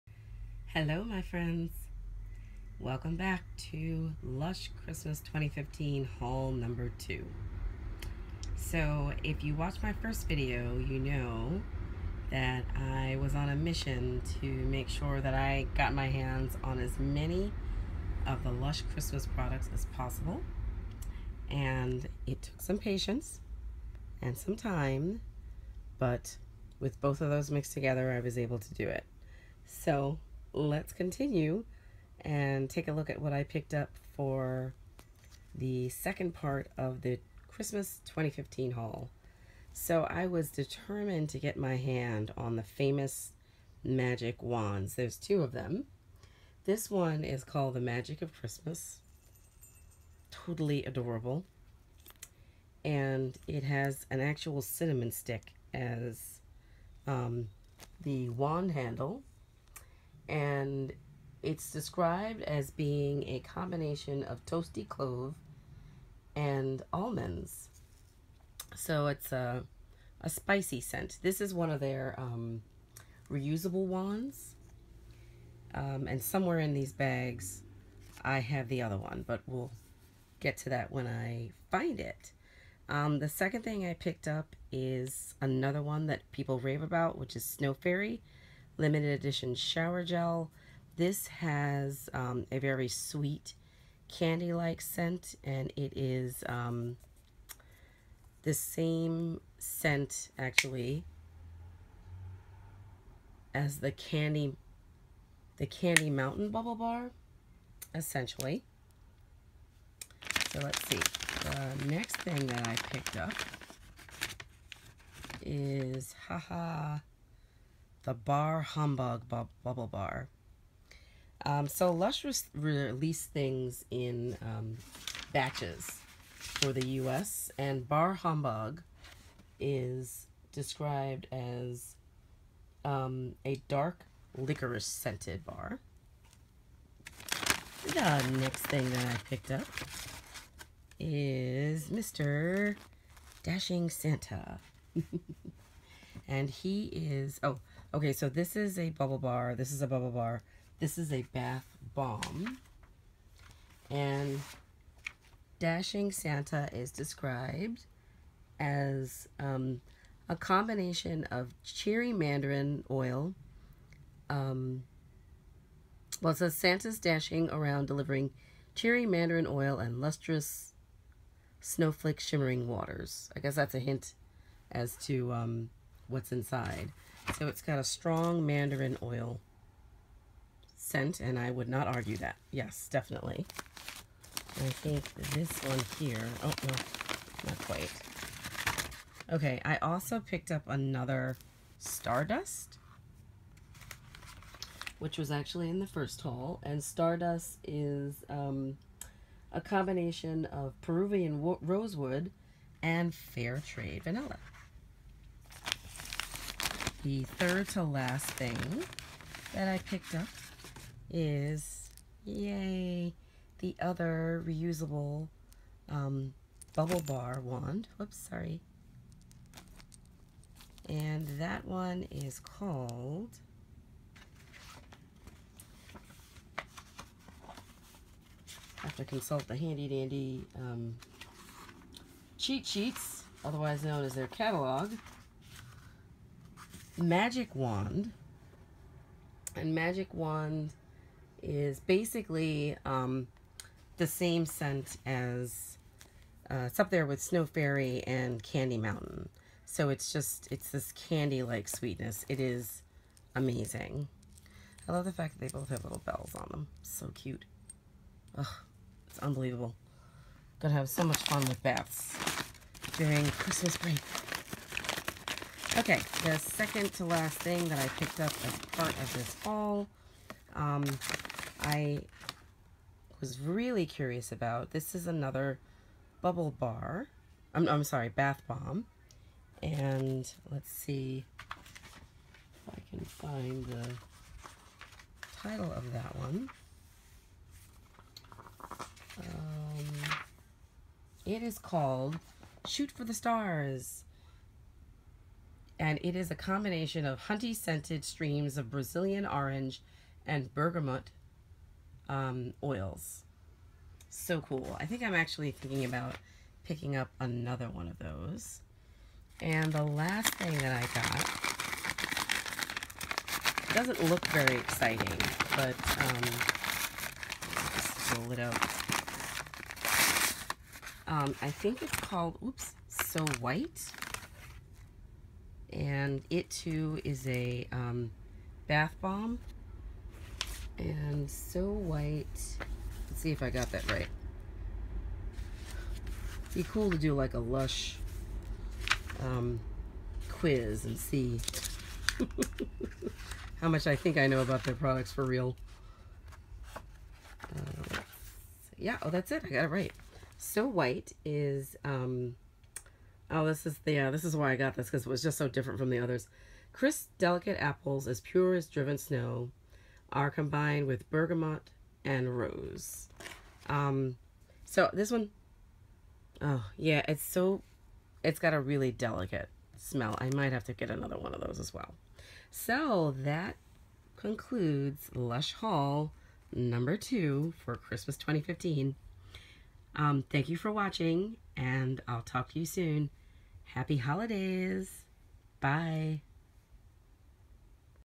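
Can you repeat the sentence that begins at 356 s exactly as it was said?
Crisp, delicate apples as pure as driven snow are combined with bergamot and rose.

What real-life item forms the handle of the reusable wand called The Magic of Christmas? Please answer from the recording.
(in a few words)
cinnamon stick.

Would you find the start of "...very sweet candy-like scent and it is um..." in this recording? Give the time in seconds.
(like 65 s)
92 s.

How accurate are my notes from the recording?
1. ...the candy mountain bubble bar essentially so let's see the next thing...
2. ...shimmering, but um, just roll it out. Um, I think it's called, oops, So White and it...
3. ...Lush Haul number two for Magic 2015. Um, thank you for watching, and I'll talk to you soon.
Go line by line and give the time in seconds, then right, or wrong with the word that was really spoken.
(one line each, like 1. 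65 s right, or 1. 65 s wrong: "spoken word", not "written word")
1. 105 s right
2. 314 s wrong: "exciting", not "shimmering"
3. 375 s wrong: "Christmas", not "Magic".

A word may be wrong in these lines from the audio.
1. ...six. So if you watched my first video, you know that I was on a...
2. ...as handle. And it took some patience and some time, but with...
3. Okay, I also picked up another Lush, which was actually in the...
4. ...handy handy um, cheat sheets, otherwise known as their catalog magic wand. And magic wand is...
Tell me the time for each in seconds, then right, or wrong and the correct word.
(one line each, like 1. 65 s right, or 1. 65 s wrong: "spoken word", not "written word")
1. 6 s wrong: "two", not "six"
2. 19 s wrong: "possible", not "handle"
3. 189 s wrong: "Stardust", not "Lush"
4. 229 s wrong: "dandy", not "handy".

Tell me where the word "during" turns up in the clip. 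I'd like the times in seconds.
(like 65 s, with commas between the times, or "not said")
262 s.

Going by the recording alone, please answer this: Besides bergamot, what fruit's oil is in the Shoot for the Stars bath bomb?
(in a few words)
Brazilian orange.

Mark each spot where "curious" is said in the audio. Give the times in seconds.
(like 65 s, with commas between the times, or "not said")
273 s.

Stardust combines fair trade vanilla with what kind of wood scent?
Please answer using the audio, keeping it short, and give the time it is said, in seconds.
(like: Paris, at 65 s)
Peruvian rosewood, at 200 s.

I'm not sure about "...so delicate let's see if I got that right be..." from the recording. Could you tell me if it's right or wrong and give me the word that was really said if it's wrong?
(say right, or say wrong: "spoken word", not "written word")
wrong: "white", not "delicate".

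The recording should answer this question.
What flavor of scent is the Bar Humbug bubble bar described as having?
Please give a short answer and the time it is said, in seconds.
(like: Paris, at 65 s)
dark licorice, at 133 s.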